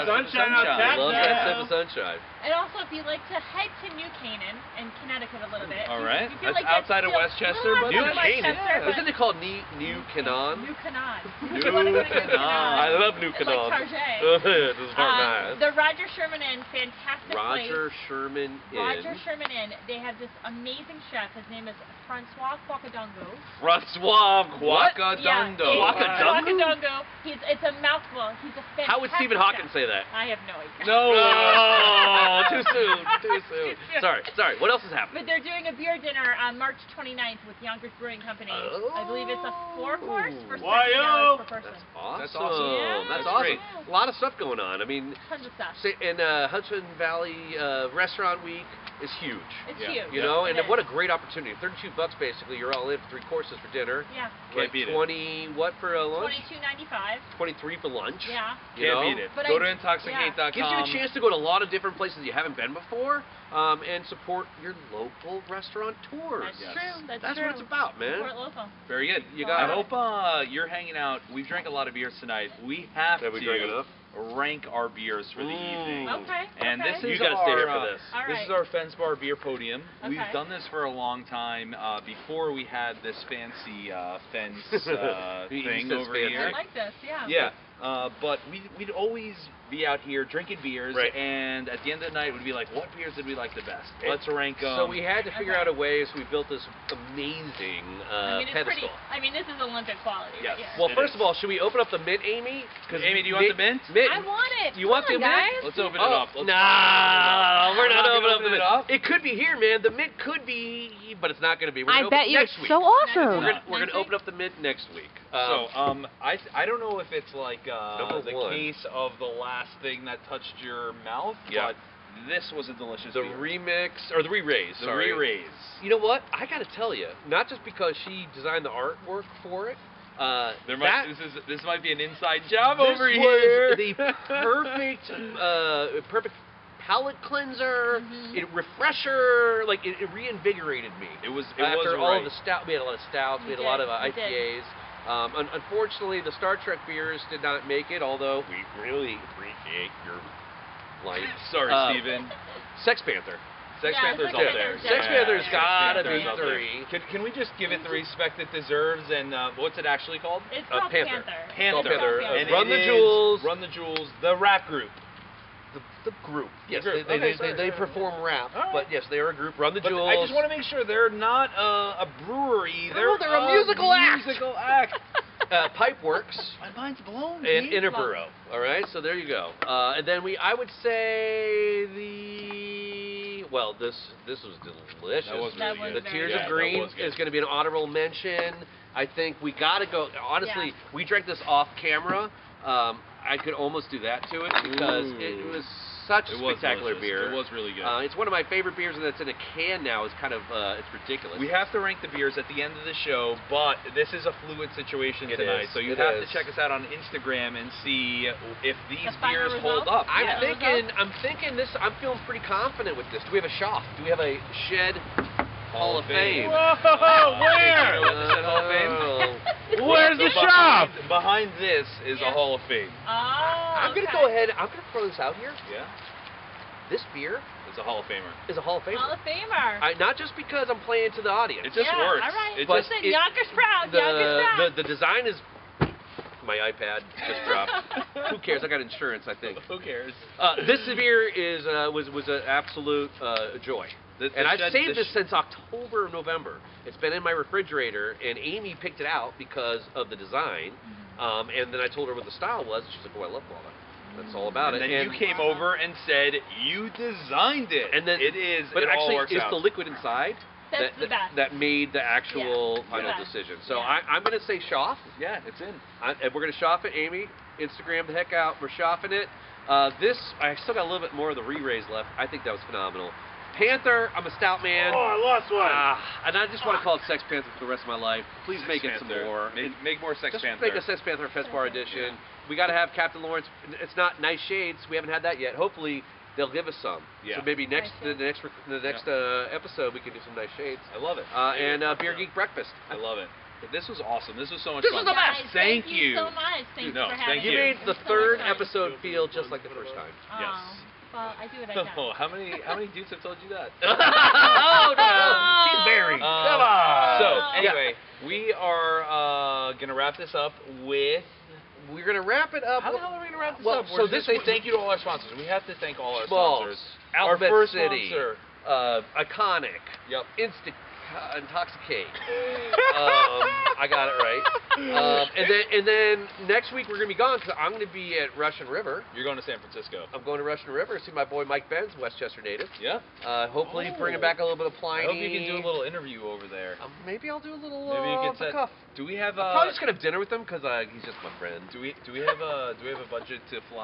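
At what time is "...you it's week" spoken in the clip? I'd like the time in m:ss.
1:52.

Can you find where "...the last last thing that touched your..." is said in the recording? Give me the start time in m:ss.
1:59.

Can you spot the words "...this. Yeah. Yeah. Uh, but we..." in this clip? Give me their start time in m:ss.
1:26.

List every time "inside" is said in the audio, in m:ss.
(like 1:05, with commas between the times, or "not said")
2:12, 4:19.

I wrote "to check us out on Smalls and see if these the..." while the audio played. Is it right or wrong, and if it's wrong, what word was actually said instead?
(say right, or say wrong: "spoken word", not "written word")
wrong: "Instagram", not "Smalls".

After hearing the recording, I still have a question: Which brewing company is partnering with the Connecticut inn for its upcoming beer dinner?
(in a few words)
Yonkers Brewing Company.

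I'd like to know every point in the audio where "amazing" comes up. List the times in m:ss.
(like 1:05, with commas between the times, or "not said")
0:20, 1:36.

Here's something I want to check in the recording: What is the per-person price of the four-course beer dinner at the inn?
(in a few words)
$70.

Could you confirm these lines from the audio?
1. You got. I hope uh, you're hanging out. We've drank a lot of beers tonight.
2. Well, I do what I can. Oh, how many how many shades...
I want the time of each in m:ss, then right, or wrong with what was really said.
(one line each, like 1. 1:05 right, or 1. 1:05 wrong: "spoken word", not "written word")
1. 1:09 right
2. 5:01 wrong: "dudes", not "shades".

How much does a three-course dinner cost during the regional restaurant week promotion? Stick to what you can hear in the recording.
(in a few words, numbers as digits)
$32.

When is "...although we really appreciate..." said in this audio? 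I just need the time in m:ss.
2:28.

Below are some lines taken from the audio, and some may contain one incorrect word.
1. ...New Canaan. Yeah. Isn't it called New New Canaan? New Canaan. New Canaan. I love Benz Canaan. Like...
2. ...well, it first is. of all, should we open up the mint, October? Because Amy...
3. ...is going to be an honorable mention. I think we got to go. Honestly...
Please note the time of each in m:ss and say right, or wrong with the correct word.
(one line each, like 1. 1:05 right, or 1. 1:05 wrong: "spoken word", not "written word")
1. 0:07 wrong: "New", not "Benz"
2. 1:40 wrong: "Amy", not "October"
3. 3:06 right.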